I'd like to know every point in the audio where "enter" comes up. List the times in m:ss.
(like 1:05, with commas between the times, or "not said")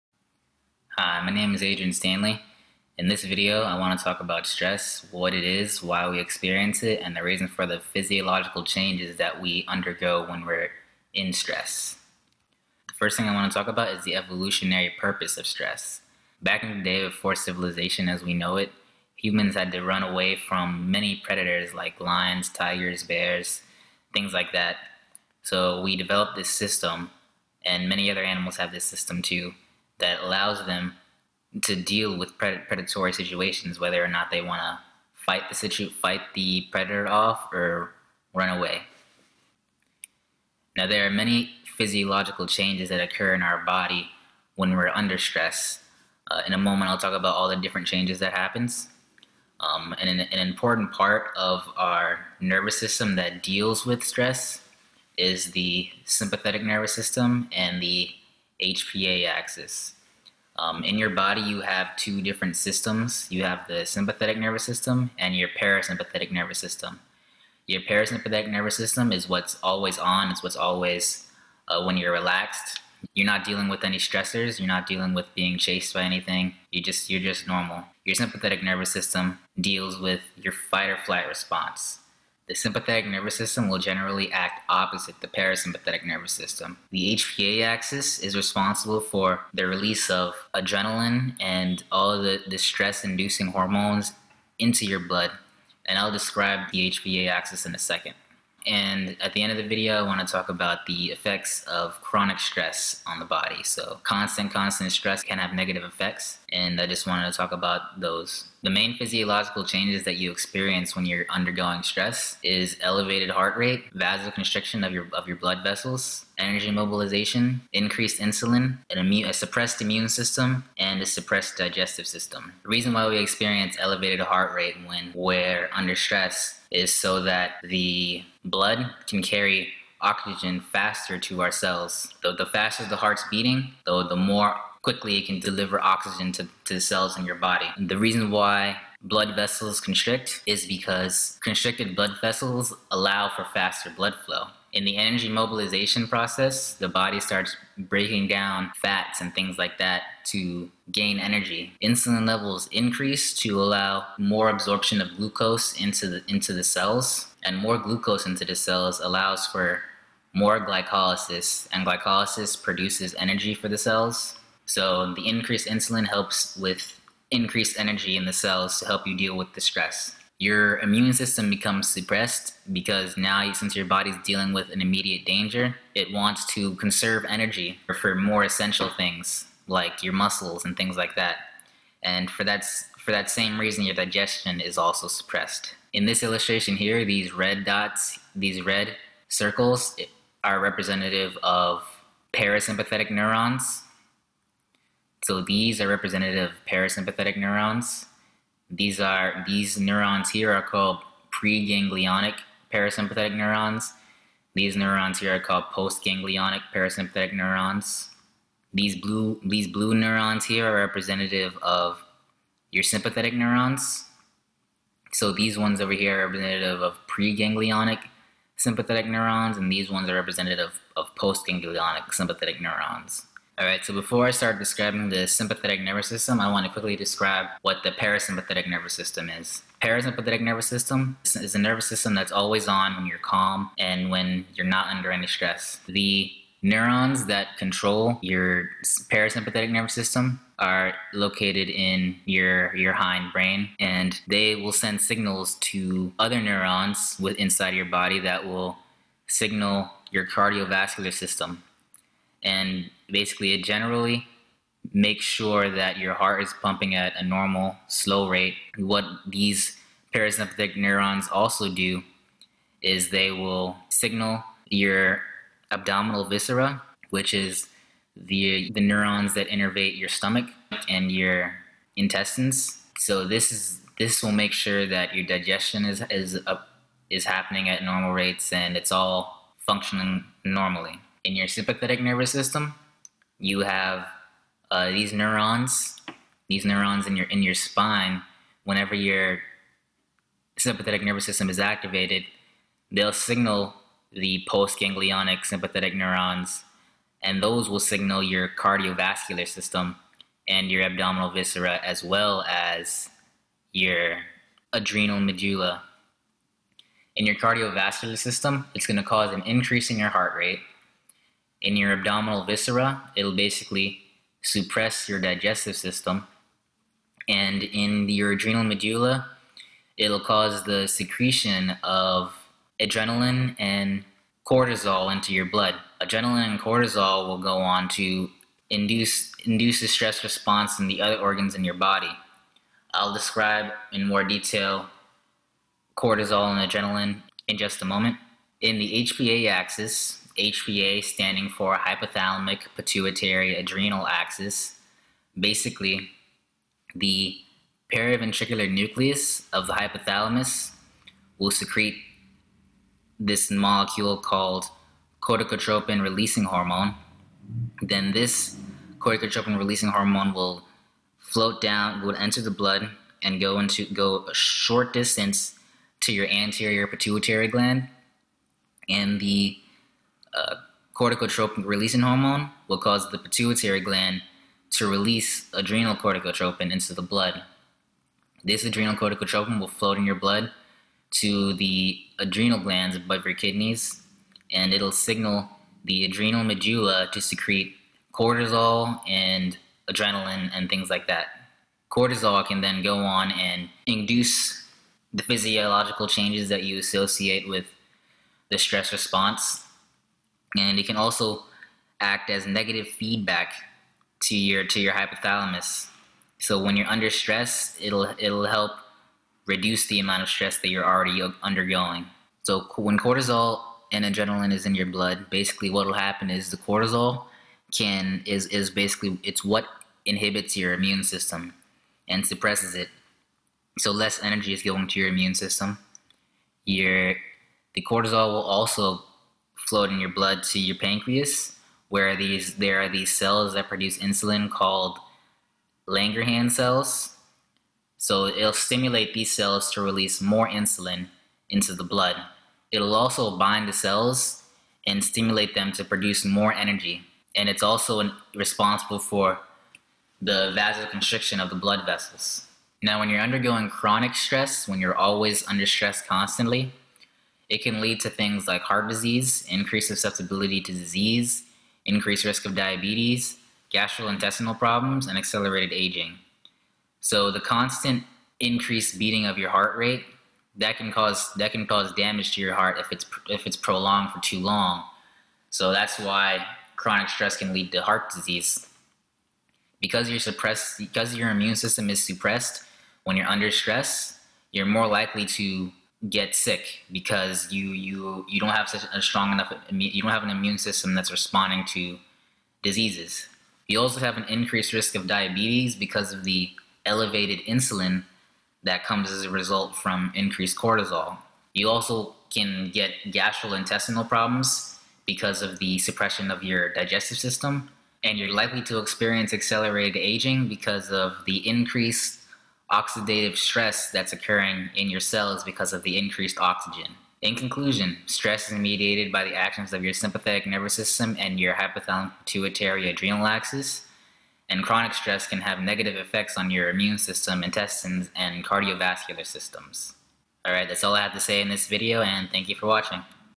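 6:02.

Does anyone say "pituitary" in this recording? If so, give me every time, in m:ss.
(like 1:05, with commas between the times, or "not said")
5:42, 6:06, 6:13, 8:42.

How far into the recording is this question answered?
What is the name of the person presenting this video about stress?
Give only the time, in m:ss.
0:01.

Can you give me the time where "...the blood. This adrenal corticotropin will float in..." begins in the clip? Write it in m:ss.
6:16.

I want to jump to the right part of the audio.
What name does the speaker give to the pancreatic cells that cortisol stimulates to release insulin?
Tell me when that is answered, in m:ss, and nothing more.
7:15.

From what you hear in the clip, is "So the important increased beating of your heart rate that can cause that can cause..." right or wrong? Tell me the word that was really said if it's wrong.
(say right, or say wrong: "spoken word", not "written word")
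wrong: "constant", not "important".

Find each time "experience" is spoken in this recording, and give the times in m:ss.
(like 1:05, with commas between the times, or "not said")
0:06, 1:50, 2:03, 8:28.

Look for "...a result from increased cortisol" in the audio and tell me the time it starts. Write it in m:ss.
8:19.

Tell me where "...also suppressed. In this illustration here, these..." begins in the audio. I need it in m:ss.
3:04.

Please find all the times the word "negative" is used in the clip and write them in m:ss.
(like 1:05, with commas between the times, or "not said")
1:45, 6:42, 8:45.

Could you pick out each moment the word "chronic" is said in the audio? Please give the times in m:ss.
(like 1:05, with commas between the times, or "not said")
1:42, 7:33, 7:56, 8:44.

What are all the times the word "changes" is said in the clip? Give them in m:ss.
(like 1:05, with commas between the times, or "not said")
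0:08, 0:42, 0:47, 1:49, 6:36.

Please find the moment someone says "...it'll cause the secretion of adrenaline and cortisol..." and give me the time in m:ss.
5:19.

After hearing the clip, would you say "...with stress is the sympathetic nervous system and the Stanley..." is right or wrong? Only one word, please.
wrong.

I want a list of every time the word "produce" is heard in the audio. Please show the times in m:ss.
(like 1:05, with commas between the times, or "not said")
2:42, 7:13, 7:25.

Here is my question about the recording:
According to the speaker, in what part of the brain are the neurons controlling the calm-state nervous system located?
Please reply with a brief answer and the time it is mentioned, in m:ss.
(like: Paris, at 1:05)
hind brain, at 4:02.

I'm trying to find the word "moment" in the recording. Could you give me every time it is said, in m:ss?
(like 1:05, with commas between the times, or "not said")
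0:46, 5:37.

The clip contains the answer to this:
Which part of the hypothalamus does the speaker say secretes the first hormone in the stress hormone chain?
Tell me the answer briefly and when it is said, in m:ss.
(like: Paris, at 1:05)
periventricular nucleus, at 5:47.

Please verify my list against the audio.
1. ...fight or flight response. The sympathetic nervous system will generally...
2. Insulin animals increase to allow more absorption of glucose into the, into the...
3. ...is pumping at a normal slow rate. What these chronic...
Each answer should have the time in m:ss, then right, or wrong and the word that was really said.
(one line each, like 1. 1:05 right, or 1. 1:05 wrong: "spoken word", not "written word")
1. 1:20 right
2. 2:31 wrong: "levels", not "animals"
3. 4:16 wrong: "parasympathetic", not "chronic".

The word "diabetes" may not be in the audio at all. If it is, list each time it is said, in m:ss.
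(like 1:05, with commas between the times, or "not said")
7:42, 8:15.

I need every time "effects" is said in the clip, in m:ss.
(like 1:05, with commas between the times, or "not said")
1:41, 1:45, 8:45.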